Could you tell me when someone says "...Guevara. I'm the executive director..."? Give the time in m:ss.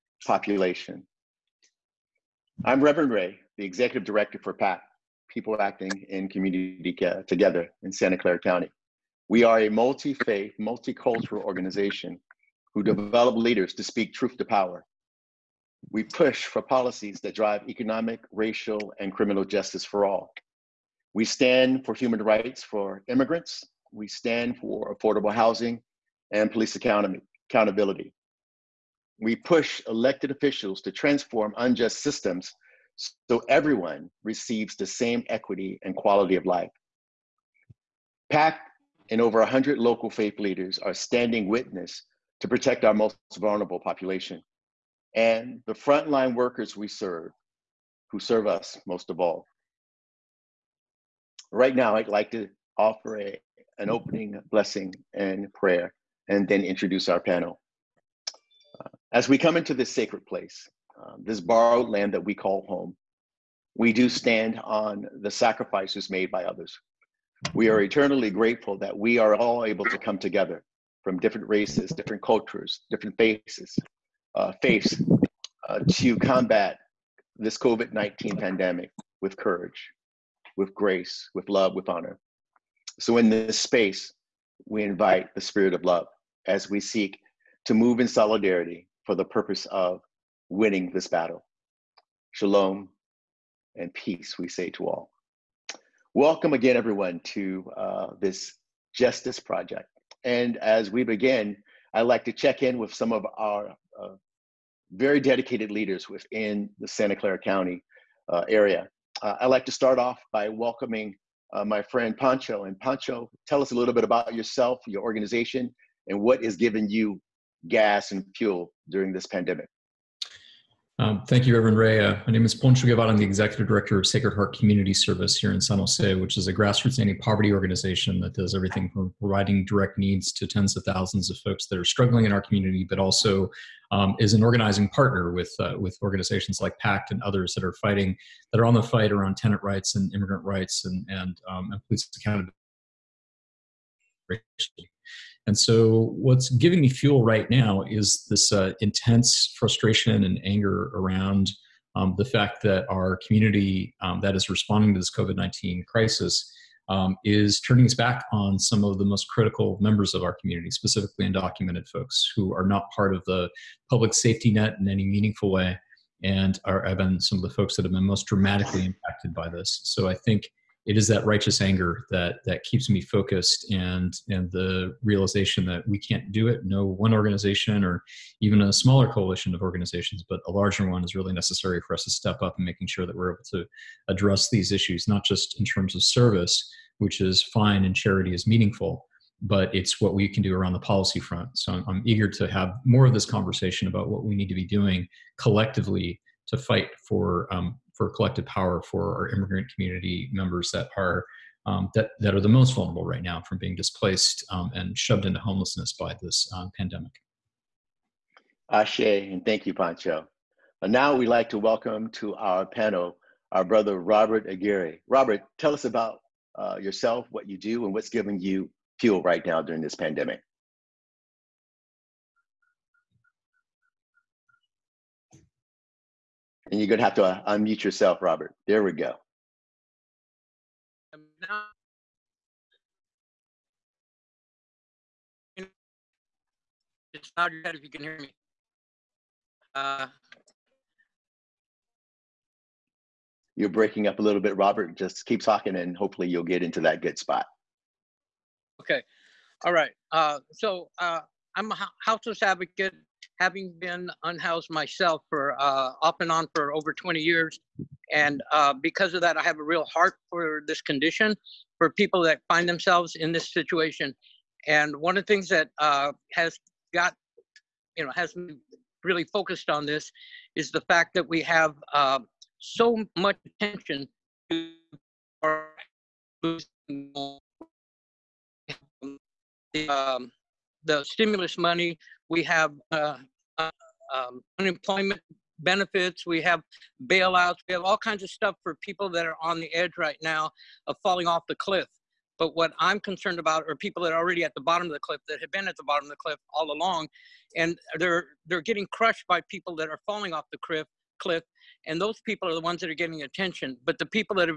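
2:02.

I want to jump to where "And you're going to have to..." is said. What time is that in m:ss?
3:46.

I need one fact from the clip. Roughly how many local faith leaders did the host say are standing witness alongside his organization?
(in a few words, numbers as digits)
over 100.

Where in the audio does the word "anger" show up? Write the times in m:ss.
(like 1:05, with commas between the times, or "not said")
2:30, 2:51.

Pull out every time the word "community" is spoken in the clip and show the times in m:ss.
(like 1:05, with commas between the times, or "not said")
0:06, 2:04, 2:12, 2:33, 2:40, 3:19.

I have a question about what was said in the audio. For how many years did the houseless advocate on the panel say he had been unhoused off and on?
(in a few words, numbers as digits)
over 20 years.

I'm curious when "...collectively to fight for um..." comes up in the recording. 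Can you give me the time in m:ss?
3:15.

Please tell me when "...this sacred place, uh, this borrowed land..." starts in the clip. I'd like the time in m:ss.
0:59.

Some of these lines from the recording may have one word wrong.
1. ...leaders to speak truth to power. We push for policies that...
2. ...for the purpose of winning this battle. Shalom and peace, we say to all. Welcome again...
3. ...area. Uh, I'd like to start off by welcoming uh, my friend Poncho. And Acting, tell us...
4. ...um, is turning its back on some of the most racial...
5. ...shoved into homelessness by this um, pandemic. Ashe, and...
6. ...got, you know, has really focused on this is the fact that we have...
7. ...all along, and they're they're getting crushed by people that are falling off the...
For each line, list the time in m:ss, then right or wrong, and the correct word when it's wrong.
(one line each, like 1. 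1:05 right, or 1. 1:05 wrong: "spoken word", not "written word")
1. 0:13 right
2. 1:29 right
3. 1:48 wrong: "Poncho", not "Acting"
4. 2:36 wrong: "critical", not "racial"
5. 3:24 right
6. 4:26 right
7. 4:56 right.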